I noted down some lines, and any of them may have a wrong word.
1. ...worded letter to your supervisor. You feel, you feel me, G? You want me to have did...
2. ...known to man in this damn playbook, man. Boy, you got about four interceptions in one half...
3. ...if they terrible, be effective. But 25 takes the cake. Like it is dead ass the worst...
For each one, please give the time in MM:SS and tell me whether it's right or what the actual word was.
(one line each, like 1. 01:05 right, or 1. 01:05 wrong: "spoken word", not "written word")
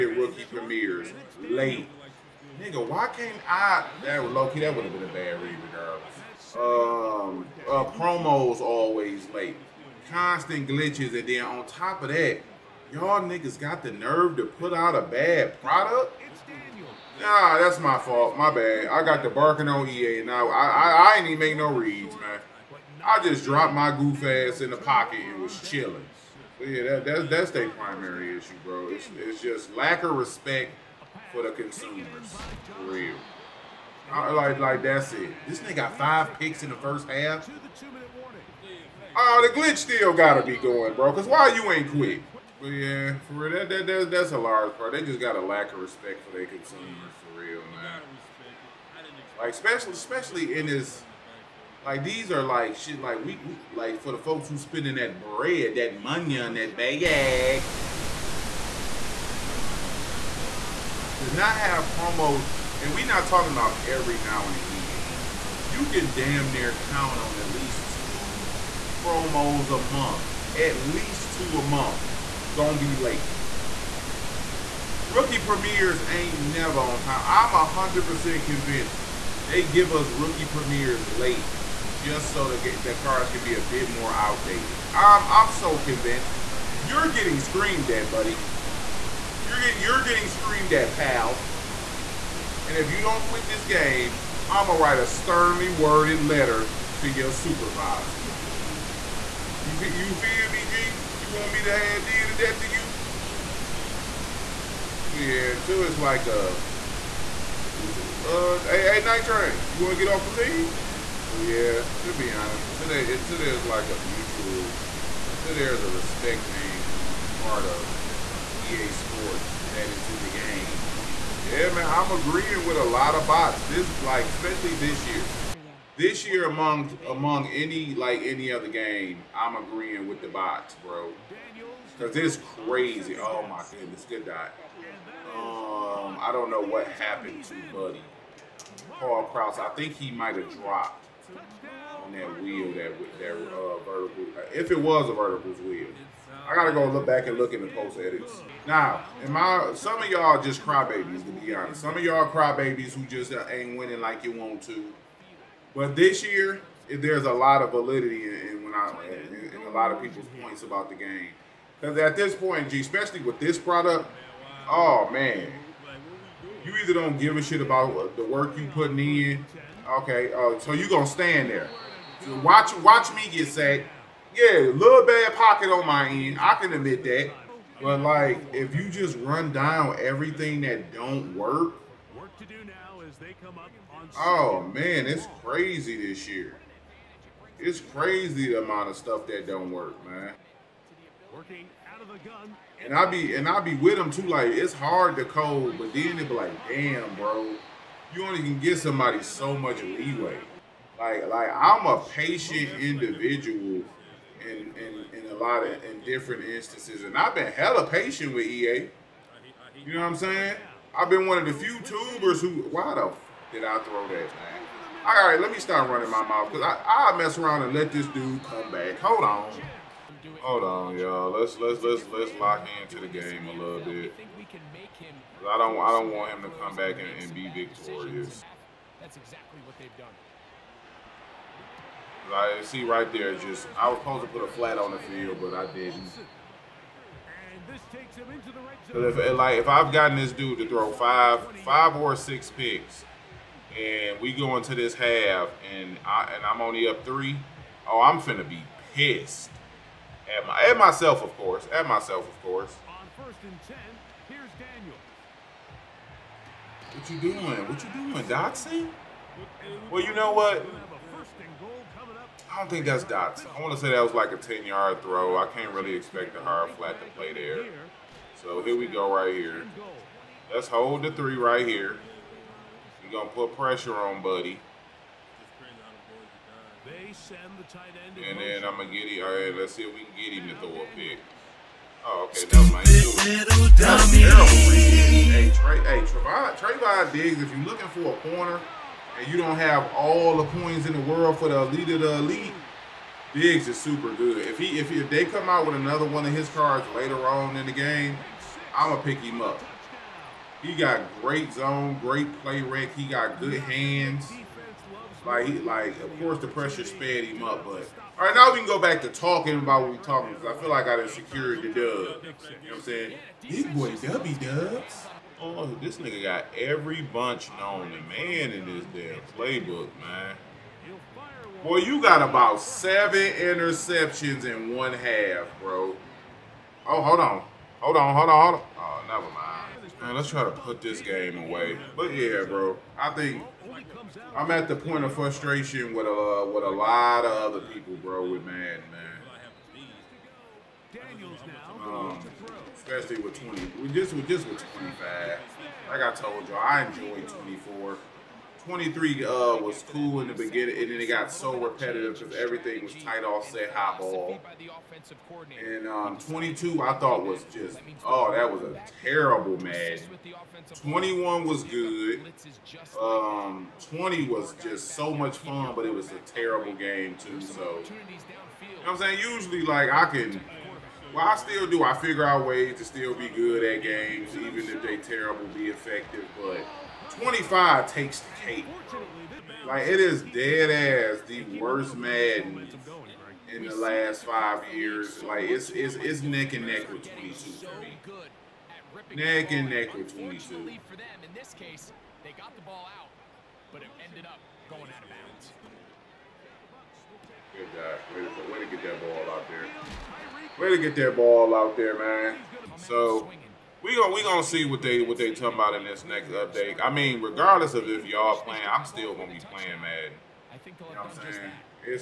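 1. 01:35 right
2. 05:17 wrong: "seven", not "four"
3. 06:14 right.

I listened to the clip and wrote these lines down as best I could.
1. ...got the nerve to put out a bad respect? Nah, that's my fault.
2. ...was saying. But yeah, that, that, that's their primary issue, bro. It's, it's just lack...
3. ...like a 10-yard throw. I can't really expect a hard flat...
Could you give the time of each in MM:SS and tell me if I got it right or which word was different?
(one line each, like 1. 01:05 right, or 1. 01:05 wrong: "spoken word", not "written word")
1. 00:13 wrong: "product", not "respect"
2. 00:25 wrong: "chilling", not "saying"
3. 04:24 right.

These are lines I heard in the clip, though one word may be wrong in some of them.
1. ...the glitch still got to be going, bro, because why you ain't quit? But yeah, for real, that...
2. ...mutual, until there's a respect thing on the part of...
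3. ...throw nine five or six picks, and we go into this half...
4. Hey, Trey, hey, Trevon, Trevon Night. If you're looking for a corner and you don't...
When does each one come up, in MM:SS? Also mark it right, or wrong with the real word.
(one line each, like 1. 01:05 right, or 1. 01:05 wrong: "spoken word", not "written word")
1. 00:39 right
2. 01:54 right
3. 04:00 wrong: "five", not "nine"
4. 04:45 wrong: "Diggs", not "Night".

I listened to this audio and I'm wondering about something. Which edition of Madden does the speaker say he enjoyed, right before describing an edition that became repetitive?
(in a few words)
Madden 24.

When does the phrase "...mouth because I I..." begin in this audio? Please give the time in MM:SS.
03:36.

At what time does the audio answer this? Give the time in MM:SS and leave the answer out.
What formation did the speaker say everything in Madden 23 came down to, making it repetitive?
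05:52.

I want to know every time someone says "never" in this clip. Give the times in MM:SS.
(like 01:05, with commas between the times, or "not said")
01:16, 05:29.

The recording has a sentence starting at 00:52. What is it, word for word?
Like we, we like for the folks who spending that bread, that money on that bag.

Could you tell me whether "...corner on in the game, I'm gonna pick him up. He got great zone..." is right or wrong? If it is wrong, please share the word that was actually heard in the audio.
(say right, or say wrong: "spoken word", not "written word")
wrong: "later", not "corner".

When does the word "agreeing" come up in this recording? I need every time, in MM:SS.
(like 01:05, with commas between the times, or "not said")
02:02, 02:09.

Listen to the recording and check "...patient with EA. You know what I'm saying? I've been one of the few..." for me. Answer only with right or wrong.
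right.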